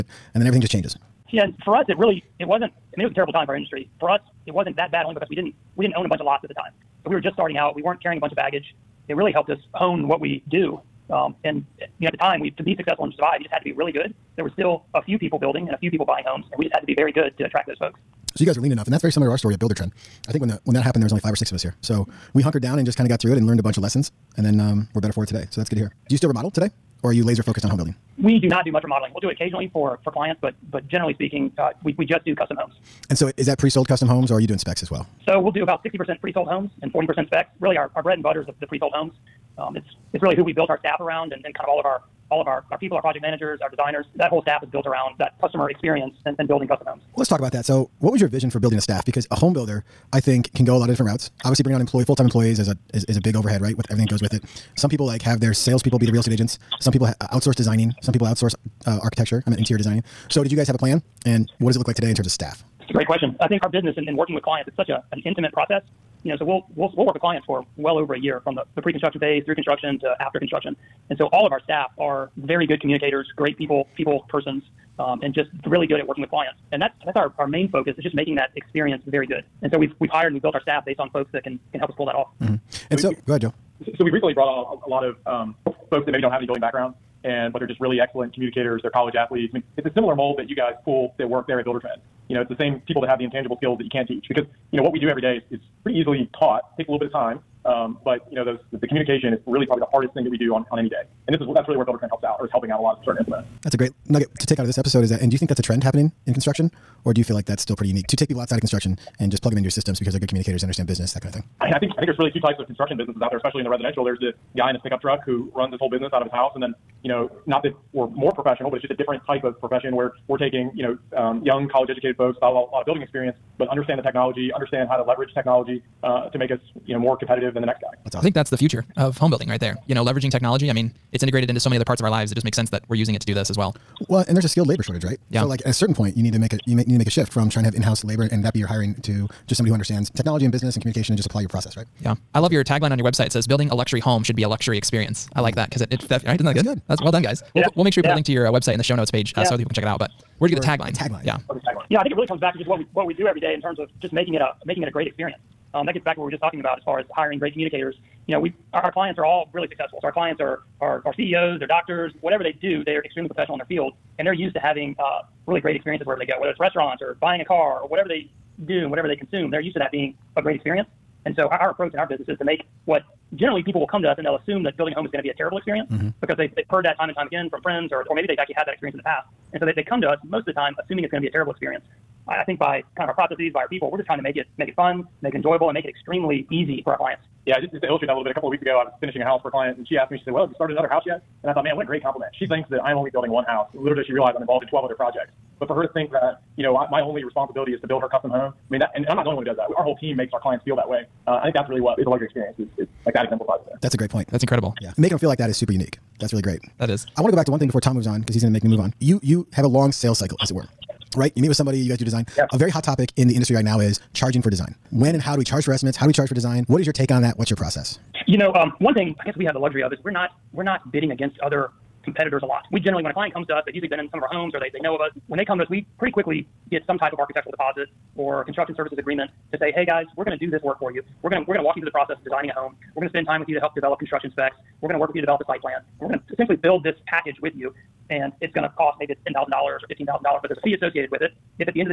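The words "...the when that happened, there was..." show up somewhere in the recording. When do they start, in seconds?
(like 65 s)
20 s.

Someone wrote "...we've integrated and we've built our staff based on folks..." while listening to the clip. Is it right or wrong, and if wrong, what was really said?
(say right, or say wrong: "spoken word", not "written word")
wrong: "hired", not "integrated".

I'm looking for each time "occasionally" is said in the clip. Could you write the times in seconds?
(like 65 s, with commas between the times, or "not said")
29 s.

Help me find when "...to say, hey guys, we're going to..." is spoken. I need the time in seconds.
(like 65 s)
229 s.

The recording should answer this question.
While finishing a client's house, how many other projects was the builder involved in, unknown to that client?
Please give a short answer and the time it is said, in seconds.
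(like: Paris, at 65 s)
12, at 194 s.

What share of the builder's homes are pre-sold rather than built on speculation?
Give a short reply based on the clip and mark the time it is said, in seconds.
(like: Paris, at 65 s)
60%, at 35 s.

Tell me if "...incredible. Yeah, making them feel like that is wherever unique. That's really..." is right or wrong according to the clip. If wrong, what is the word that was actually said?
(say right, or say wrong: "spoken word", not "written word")
wrong: "super", not "wherever".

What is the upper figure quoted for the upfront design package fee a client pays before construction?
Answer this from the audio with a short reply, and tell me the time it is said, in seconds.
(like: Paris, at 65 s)
$15,000, at 239 s.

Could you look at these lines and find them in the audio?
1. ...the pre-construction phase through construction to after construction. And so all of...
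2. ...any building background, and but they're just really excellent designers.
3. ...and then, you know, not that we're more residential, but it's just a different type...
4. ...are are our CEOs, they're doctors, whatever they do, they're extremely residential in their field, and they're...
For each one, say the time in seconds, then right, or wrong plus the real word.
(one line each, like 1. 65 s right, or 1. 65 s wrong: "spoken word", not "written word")
1. 68 s right
2. 86 s wrong: "communicators", not "designers"
3. 116 s wrong: "professional", not "residential"
4. 160 s wrong: "professional", not "residential".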